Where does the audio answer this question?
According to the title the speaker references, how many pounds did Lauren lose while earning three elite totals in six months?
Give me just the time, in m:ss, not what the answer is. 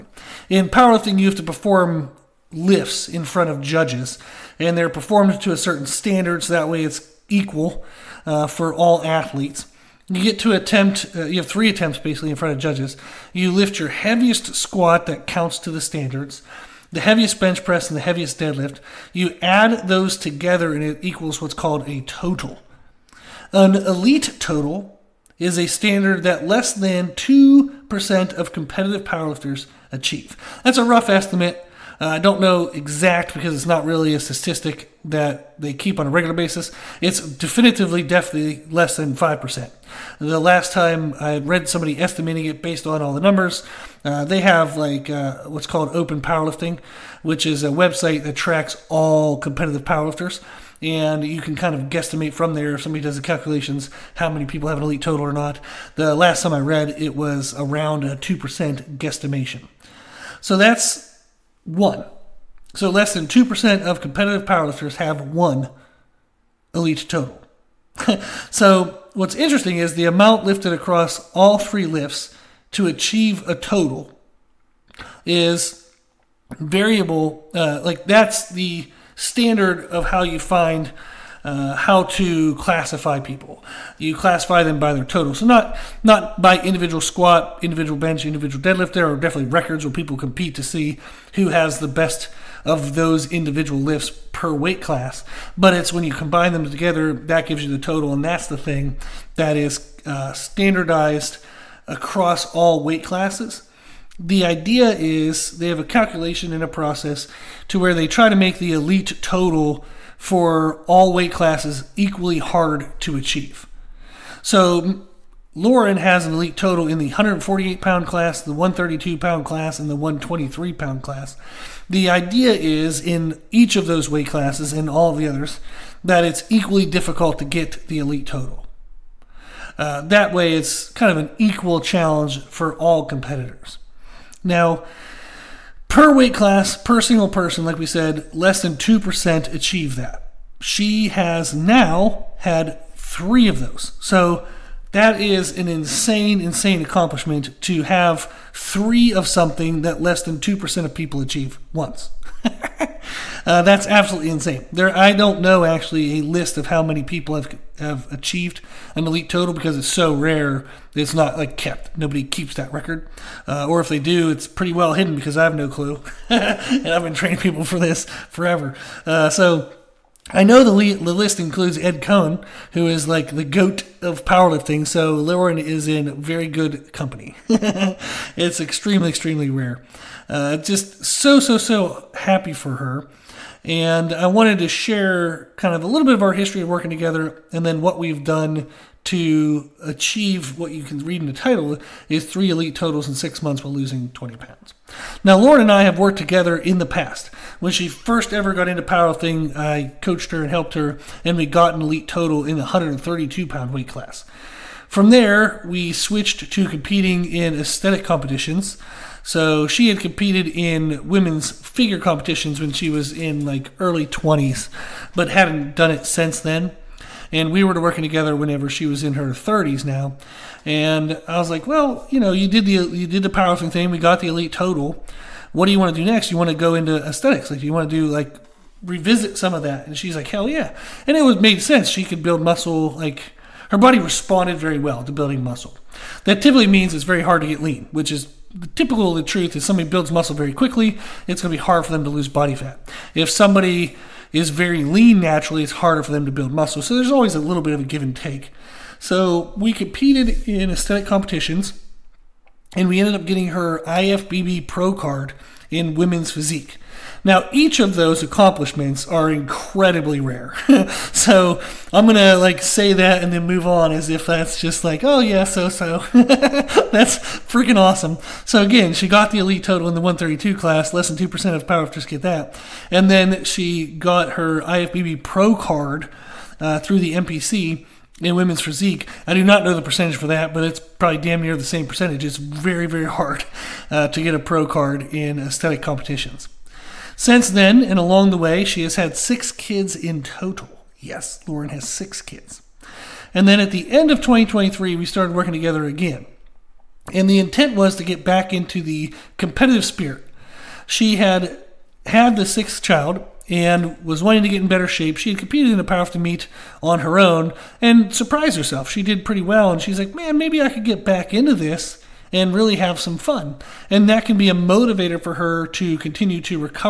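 3:14.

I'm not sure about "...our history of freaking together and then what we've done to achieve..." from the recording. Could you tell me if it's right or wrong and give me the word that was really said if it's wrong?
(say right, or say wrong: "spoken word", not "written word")
wrong: "working", not "freaking".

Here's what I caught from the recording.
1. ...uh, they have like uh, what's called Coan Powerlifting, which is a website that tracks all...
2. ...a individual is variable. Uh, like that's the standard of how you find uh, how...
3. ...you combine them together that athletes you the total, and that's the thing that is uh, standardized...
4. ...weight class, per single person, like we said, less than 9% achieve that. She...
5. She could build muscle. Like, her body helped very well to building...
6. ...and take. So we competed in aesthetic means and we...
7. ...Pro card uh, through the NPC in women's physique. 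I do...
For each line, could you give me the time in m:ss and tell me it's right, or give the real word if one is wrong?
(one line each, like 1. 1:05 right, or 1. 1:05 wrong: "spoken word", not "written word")
1. 0:44 wrong: "Open", not "Coan"
2. 1:13 wrong: "total", not "individual"
3. 1:36 wrong: "gives", not "athletes"
4. 2:16 wrong: "2", not "9"
5. 3:51 wrong: "responded", not "helped"
6. 4:08 wrong: "competitions", not "means"
7. 4:35 right.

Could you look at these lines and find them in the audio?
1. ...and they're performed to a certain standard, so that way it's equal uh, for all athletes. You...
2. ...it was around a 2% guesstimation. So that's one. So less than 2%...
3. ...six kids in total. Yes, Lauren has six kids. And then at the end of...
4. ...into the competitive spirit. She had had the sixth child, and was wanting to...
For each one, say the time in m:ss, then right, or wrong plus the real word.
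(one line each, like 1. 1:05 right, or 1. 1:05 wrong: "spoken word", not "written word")
1. 0:04 right
2. 0:56 right
3. 4:49 right
4. 4:58 right.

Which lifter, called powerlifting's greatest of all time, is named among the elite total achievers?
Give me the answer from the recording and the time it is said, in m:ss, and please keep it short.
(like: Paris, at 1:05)
Ed Coan, at 2:51.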